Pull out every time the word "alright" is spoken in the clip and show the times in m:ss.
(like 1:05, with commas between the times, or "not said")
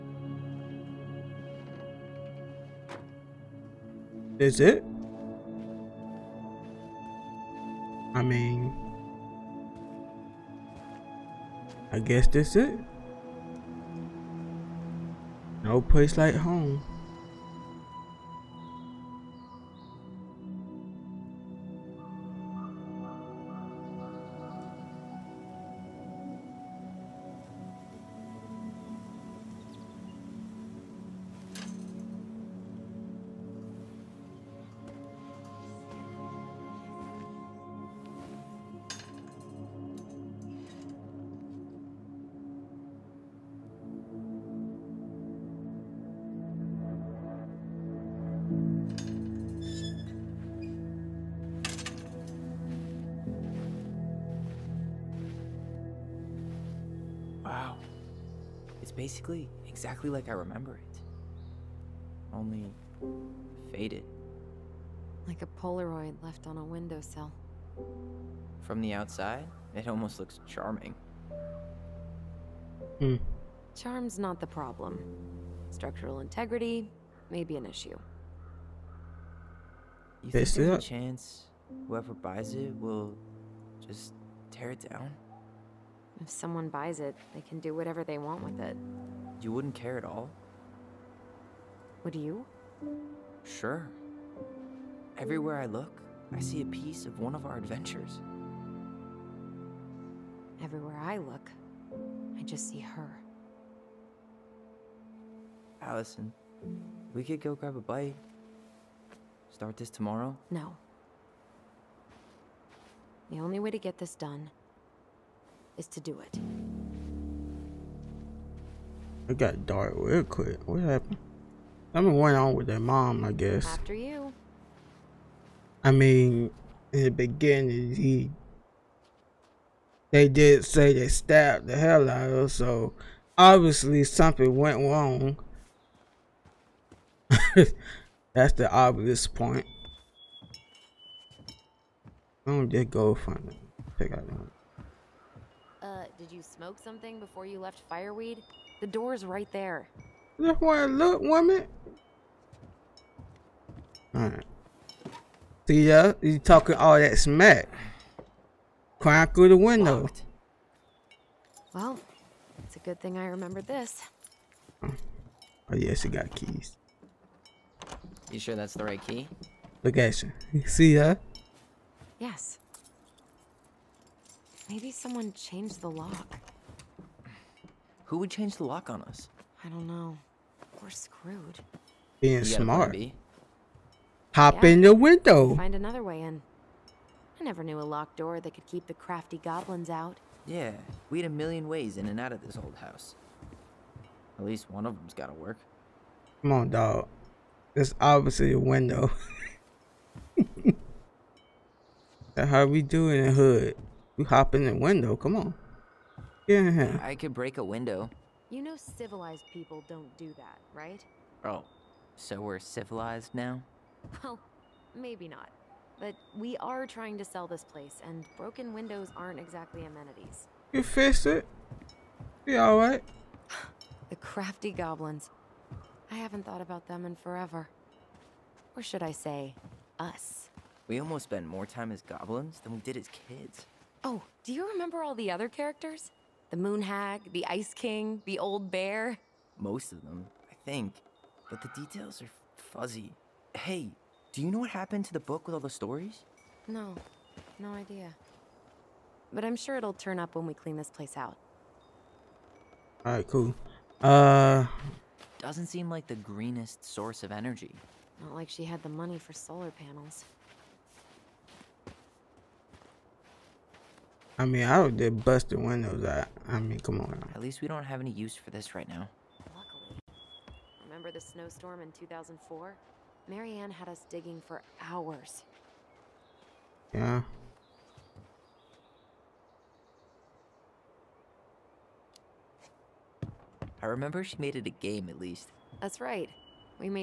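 2:34, 3:42, 4:13.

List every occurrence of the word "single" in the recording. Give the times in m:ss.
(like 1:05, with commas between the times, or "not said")
not said.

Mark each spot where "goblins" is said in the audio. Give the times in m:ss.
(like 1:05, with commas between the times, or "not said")
3:09, 3:44, 3:52.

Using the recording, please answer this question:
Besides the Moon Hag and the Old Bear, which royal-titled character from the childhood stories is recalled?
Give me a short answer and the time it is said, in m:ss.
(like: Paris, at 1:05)
the Ice King, at 3:57.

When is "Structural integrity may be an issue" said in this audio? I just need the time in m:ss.
1:15.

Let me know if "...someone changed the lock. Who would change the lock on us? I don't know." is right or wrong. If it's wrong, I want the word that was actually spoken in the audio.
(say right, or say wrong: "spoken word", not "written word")
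right.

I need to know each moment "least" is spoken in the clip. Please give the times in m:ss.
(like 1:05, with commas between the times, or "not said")
3:14, 4:27, 4:45.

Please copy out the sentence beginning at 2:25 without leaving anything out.
Uh, did you smoke something before you left Fireweed?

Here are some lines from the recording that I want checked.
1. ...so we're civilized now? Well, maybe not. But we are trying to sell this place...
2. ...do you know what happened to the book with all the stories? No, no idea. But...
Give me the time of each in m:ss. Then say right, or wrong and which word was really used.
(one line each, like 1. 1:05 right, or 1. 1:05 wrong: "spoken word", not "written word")
1. 3:32 right
2. 4:04 right.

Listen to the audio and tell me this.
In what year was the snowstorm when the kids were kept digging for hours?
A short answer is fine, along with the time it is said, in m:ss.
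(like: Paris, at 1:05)
2004, at 4:31.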